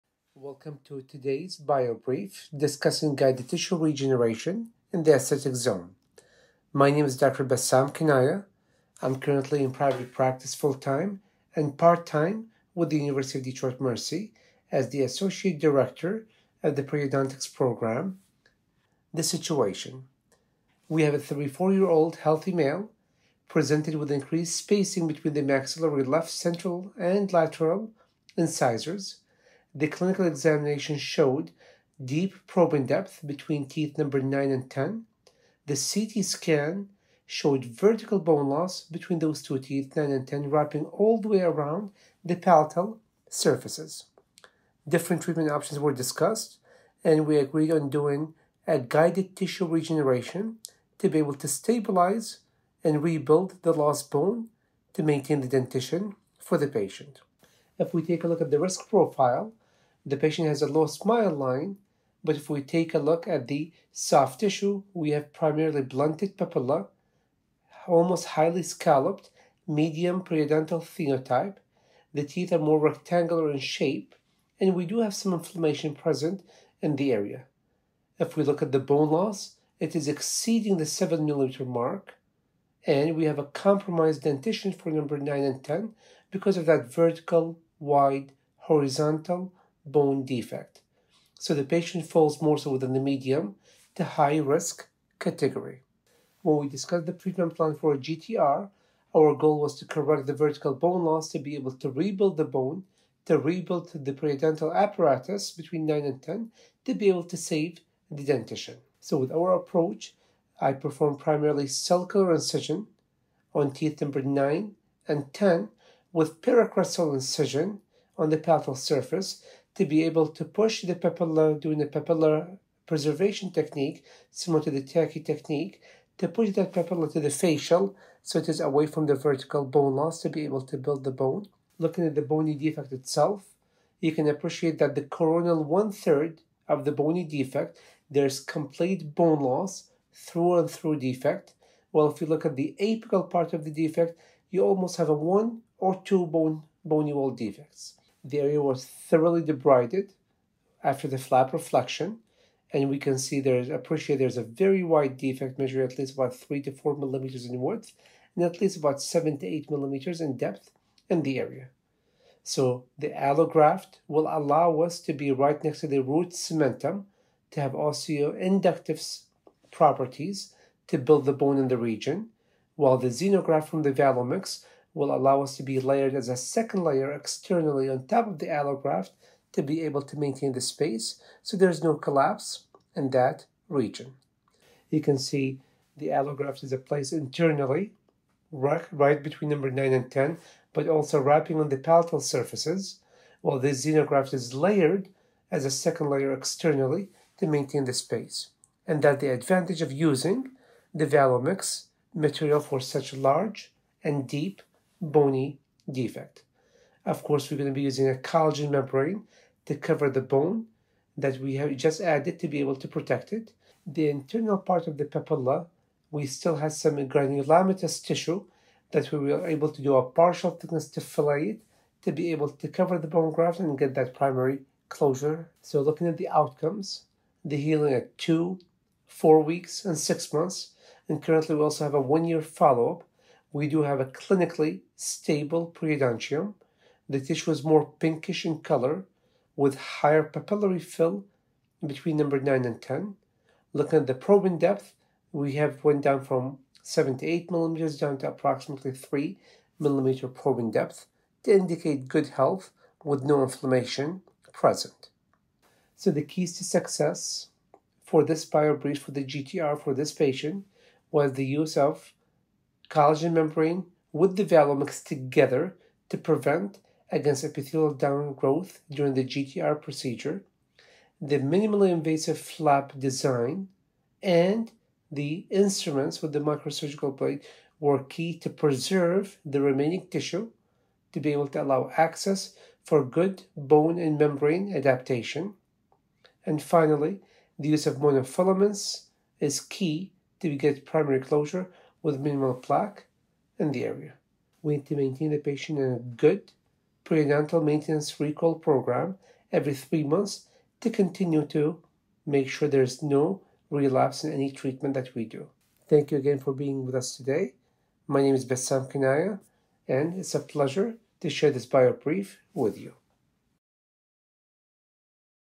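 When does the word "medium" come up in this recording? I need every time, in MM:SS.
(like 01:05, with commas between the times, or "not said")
01:09, 01:32.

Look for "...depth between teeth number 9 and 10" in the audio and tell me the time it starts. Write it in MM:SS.
00:32.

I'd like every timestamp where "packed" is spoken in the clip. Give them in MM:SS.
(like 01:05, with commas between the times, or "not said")
not said.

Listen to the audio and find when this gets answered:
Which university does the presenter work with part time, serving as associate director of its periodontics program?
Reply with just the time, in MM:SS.
00:12.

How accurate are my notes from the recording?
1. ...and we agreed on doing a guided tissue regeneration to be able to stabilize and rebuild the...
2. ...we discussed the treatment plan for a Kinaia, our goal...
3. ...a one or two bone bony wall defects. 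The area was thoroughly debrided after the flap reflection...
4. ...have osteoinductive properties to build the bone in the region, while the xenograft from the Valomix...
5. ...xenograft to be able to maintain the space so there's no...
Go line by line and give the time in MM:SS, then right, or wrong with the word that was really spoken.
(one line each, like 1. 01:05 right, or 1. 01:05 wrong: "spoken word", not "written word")
1. 00:47 right
2. 01:36 wrong: "GTR", not "Kinaia"
3. 02:25 right
4. 02:47 right
5. 02:58 wrong: "allograft", not "xenograft".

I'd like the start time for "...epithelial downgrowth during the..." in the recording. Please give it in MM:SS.
04:27.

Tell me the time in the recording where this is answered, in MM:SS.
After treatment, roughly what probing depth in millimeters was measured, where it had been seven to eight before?
04:08.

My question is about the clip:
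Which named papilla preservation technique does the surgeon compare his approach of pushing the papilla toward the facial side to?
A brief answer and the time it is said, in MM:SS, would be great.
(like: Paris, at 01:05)
Takei technique, at 02:04.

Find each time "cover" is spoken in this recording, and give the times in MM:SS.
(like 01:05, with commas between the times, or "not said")
03:29, 03:42.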